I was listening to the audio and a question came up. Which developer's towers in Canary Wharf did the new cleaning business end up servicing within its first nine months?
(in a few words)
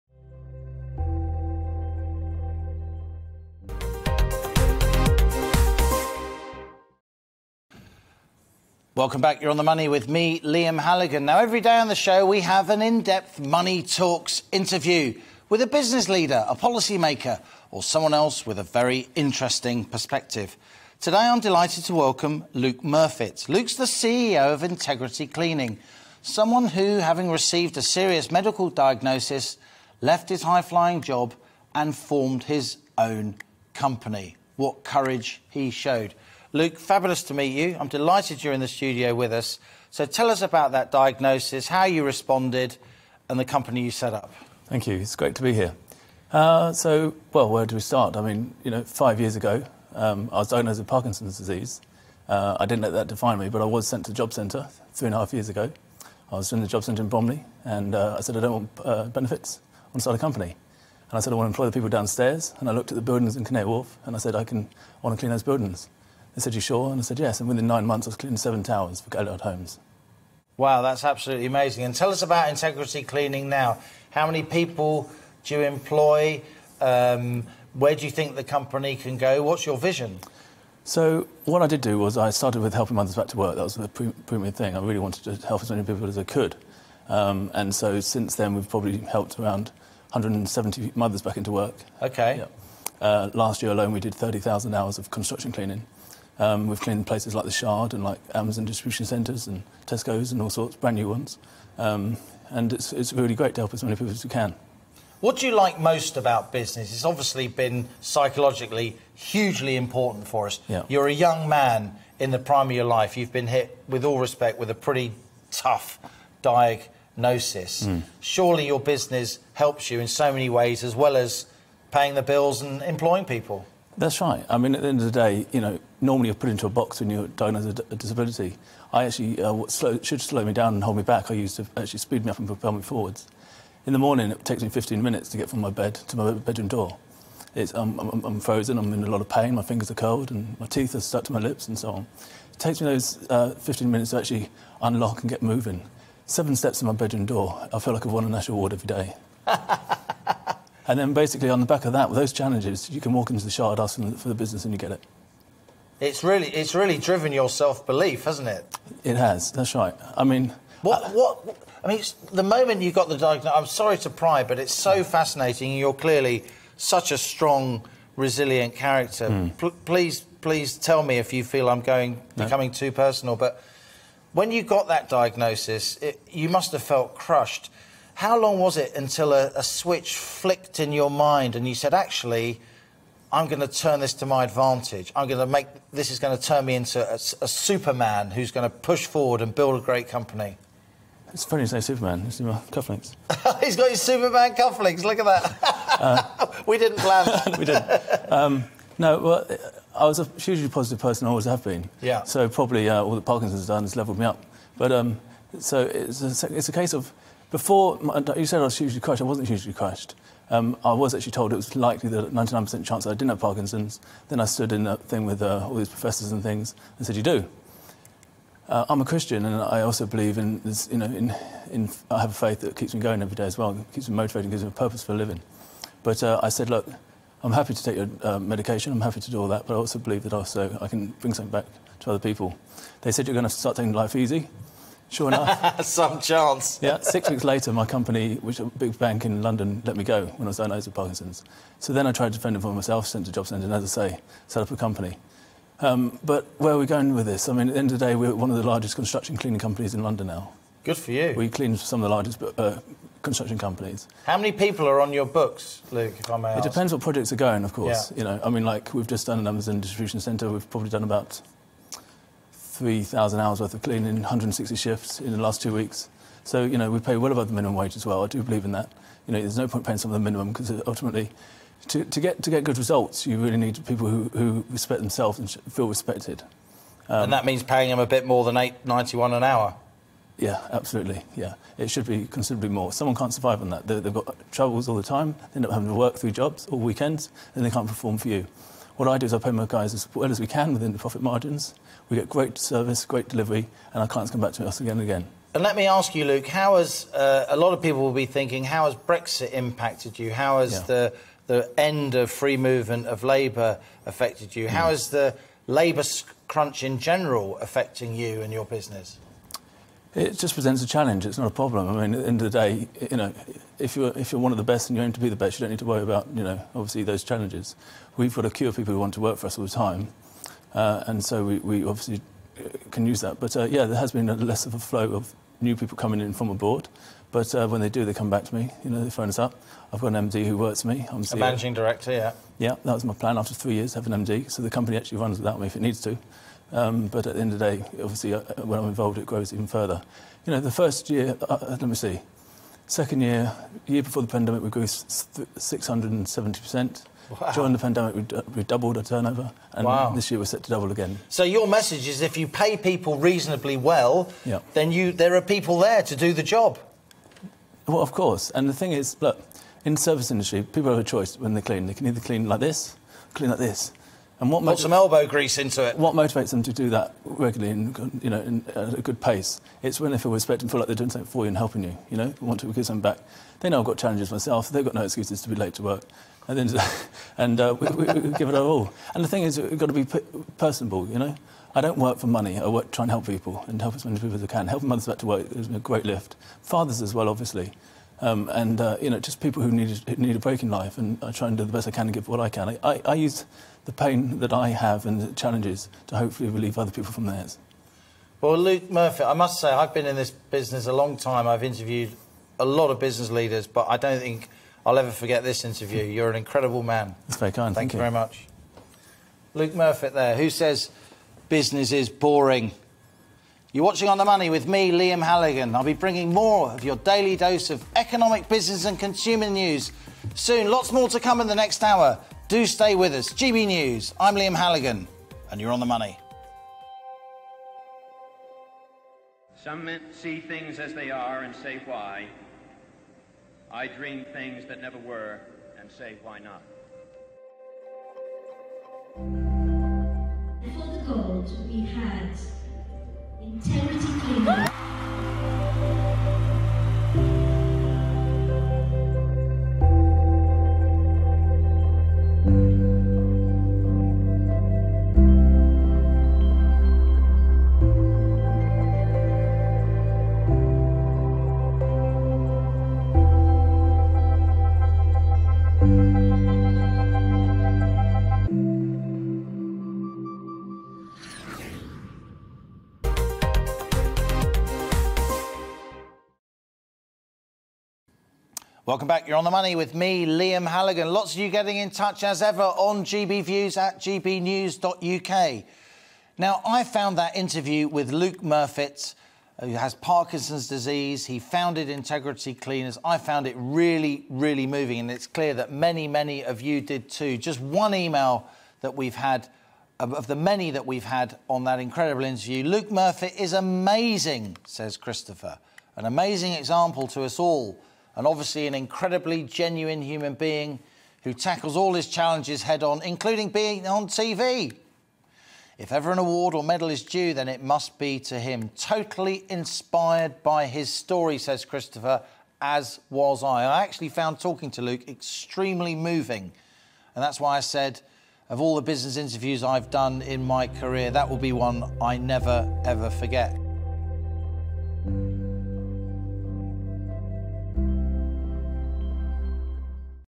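Galliard Homes.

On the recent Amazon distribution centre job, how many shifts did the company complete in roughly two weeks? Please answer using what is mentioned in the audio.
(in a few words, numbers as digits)
160.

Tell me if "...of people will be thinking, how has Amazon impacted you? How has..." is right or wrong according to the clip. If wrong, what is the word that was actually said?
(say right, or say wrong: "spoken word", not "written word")
wrong: "Brexit", not "Amazon".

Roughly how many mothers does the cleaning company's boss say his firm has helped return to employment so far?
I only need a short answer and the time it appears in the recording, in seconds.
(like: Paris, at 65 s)
170, at 90 s.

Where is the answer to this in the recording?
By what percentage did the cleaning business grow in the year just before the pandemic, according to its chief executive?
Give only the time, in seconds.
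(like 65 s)
344 s.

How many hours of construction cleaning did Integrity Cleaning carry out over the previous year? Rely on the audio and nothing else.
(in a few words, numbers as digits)
30,000.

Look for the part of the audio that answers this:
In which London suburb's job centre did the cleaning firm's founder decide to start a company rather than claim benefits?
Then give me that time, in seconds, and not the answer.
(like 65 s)
57 s.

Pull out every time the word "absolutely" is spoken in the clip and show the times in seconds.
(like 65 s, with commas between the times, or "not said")
71 s, 280 s.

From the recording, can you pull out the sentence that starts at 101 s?
Um, and it's, it's really great to help as many people as we can.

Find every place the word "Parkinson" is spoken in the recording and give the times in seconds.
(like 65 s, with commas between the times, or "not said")
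50 s, 203 s, 213 s, 240 s, 489 s.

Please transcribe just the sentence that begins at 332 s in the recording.
Yeah, that was my plan after three years, have an MD.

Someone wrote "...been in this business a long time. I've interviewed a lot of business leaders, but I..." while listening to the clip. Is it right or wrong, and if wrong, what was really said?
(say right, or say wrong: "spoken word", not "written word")
right.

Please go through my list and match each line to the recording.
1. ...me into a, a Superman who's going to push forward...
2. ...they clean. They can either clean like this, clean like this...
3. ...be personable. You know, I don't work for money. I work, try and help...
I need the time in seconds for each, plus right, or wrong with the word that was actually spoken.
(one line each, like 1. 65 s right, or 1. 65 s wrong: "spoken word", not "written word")
1. 186 s right
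2. 361 s right
3. 379 s right.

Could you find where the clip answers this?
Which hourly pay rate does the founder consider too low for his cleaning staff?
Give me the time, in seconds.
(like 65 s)
278 s.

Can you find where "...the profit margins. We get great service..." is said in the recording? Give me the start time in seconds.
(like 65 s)
290 s.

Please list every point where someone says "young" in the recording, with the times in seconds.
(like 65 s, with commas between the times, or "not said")
111 s.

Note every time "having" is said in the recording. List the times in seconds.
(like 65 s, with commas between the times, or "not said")
26 s, 285 s.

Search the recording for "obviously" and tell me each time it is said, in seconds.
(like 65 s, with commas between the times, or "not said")
107 s, 316 s, 321 s, 338 s, 387 s, 508 s.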